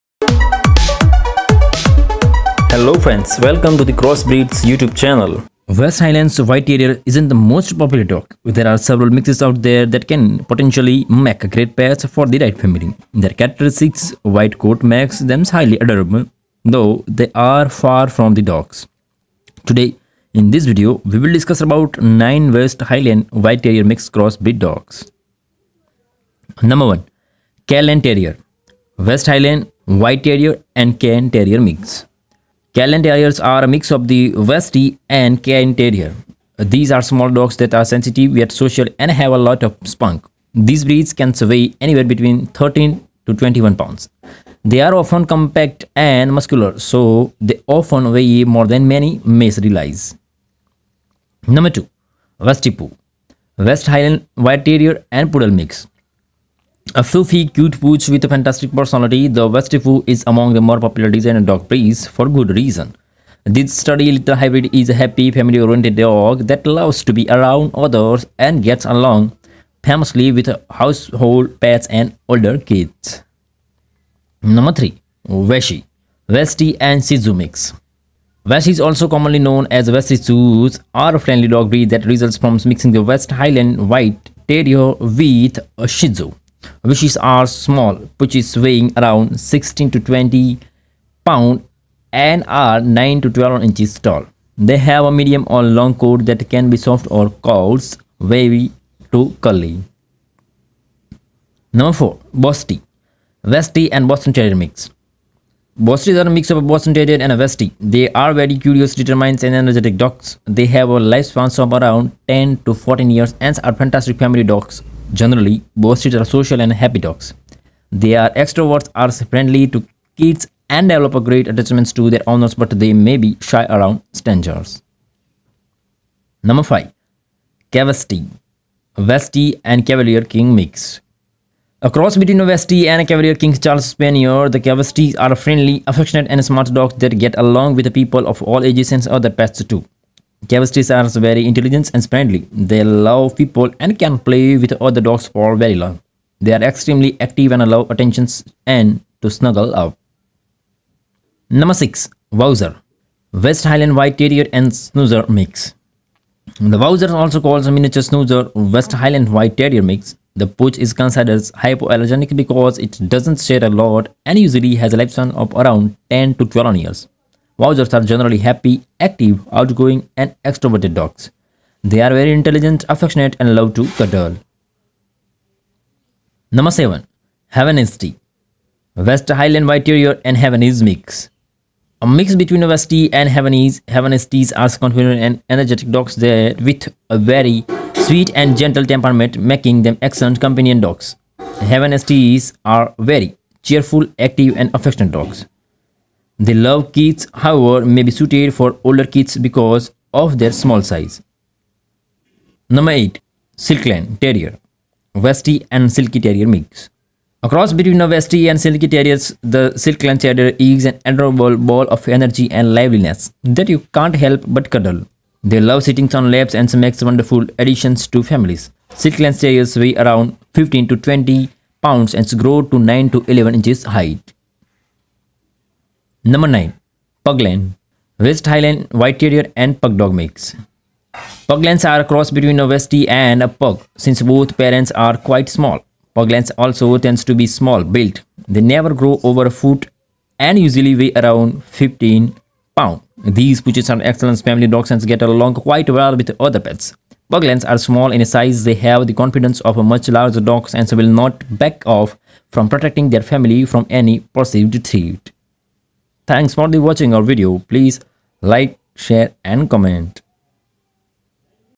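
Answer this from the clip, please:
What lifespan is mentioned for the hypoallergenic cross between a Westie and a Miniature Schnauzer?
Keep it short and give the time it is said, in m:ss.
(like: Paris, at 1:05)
10 to 12 years, at 2:46.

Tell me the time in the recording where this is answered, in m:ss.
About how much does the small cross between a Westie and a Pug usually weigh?
4:01.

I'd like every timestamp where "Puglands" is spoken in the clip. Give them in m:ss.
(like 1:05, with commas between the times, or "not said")
3:47, 3:51, 3:56, 4:07.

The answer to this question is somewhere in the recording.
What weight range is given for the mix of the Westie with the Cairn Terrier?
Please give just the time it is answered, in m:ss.
0:42.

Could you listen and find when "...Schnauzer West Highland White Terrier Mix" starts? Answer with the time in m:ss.
2:38.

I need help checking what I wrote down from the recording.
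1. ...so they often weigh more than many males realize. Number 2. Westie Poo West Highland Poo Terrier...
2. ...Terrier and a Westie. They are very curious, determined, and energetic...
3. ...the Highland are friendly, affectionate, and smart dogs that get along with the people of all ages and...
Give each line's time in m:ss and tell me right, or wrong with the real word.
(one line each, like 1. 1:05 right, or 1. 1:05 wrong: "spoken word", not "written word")
1. 0:46 wrong: "White", not "Poo"
2. 1:46 right
3. 2:14 wrong: "Cavesties", not "Highland".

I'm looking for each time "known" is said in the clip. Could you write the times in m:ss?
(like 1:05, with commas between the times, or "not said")
1:19.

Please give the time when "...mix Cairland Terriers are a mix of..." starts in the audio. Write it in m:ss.
0:31.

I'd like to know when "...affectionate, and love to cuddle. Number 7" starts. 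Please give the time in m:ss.
2:52.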